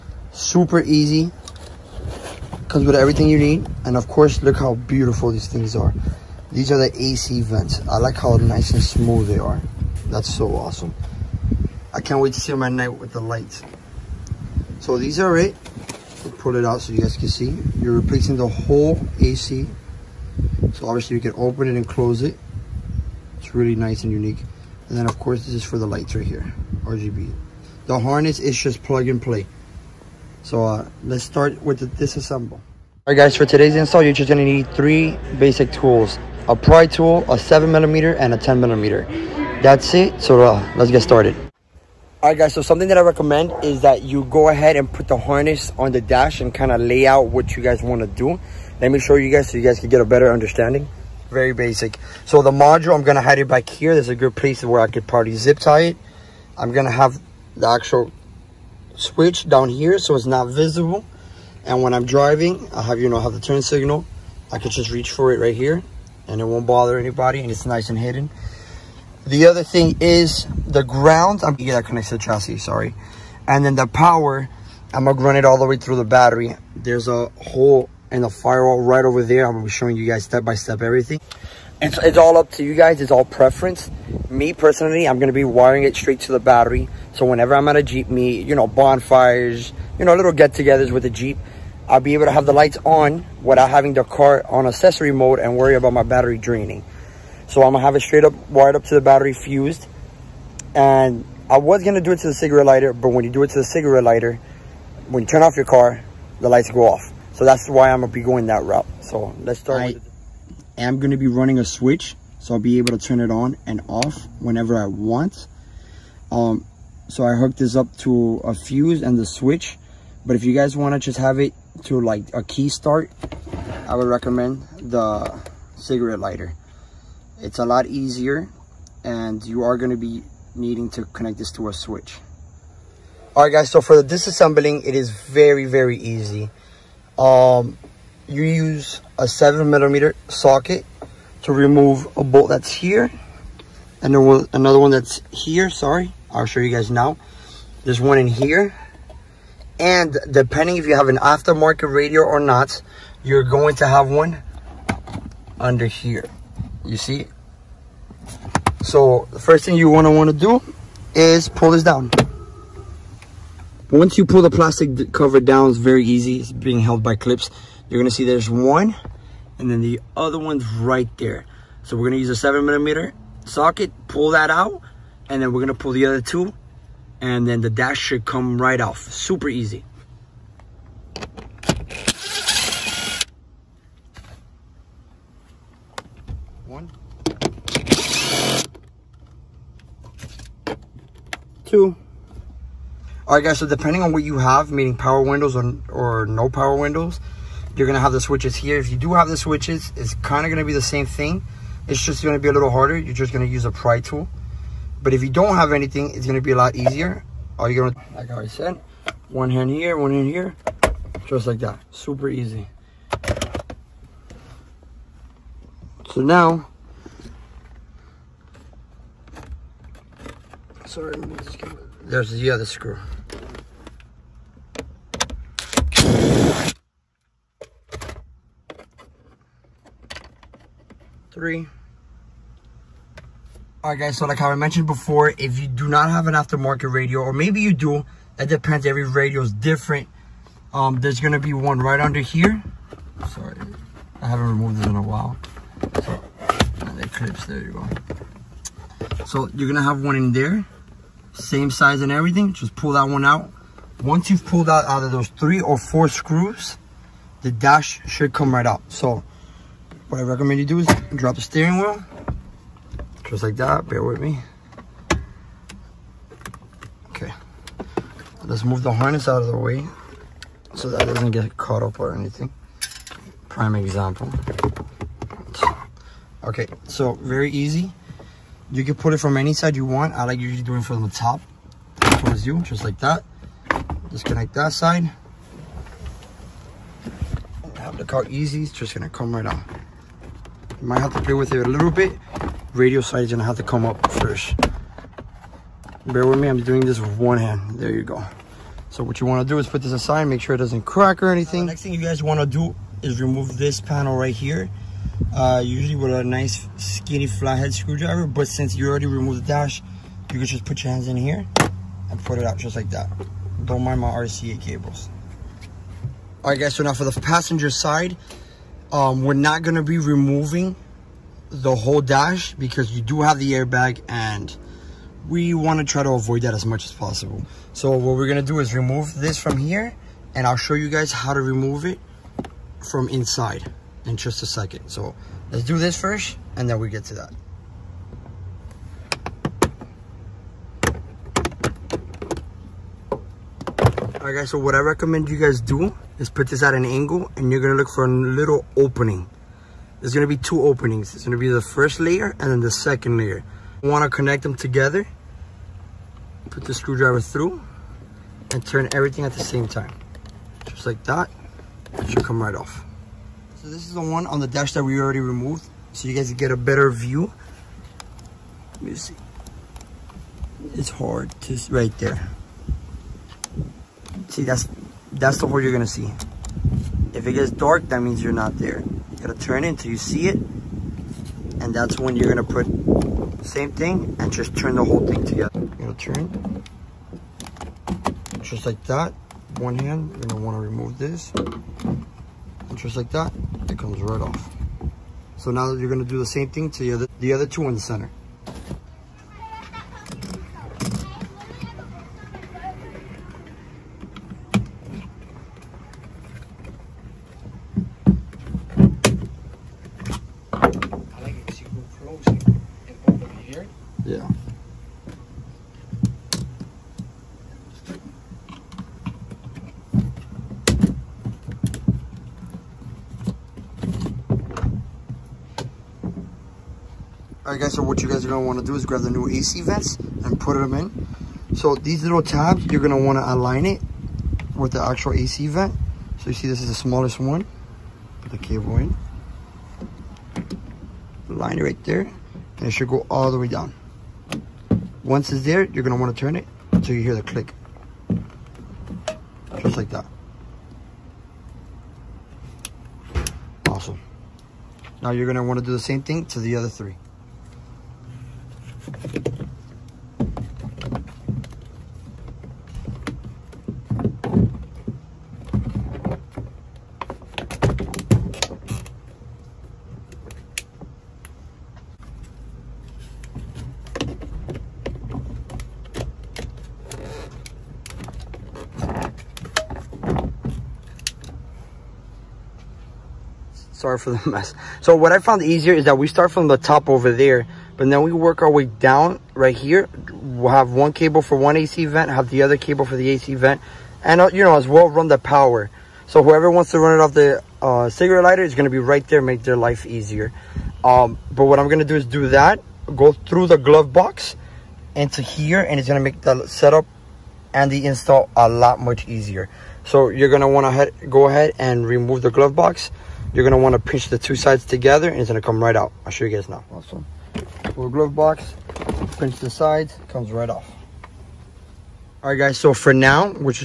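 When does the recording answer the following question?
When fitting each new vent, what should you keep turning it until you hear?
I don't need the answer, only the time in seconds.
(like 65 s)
447 s.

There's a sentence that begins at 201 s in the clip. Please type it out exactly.
It's just going to be a little harder.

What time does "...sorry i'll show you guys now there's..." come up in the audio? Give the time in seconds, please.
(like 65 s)
145 s.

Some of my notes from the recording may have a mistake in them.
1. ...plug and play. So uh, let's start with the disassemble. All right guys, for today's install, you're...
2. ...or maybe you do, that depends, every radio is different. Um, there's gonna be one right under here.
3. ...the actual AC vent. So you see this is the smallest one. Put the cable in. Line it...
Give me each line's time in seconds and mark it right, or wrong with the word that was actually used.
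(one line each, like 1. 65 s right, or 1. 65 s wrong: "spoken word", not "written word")
1. 28 s right
2. 237 s right
3. 434 s right.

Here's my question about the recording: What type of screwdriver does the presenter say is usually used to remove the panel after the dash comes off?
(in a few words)
skinny flathead.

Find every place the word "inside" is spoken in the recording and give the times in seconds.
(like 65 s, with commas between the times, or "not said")
333 s.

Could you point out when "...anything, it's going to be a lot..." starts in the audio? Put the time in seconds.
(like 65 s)
205 s.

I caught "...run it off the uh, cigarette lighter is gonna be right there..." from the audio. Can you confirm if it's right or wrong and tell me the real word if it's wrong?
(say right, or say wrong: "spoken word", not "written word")
right.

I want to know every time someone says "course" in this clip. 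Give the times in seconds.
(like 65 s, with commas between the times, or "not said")
4 s, 25 s.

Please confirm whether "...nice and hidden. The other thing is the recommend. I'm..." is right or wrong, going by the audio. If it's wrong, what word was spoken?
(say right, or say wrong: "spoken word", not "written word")
wrong: "ground", not "recommend".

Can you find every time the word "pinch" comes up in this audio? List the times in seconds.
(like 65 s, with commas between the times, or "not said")
513 s, 519 s.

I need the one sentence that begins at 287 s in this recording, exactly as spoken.
Have the car easy, it's just gonna come right on.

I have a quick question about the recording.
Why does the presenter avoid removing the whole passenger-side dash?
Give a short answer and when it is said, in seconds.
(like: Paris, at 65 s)
the airbag, at 323 s.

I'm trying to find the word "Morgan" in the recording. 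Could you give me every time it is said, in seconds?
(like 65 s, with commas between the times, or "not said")
not said.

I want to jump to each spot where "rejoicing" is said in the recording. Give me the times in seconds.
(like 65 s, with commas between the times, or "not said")
not said.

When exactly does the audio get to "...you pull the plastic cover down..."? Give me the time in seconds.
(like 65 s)
164 s.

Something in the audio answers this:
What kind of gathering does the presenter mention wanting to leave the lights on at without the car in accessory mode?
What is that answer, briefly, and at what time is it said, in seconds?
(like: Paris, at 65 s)
Jeep meet, at 87 s.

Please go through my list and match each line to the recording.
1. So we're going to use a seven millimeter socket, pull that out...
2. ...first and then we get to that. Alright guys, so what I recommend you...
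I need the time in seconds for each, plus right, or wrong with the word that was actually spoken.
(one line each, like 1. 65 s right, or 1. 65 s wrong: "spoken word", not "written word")
1. 171 s right
2. 335 s right.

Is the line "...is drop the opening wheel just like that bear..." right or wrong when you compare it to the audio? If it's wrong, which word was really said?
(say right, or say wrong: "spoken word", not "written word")
wrong: "steering", not "opening".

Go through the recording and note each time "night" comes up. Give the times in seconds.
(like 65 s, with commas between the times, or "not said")
12 s.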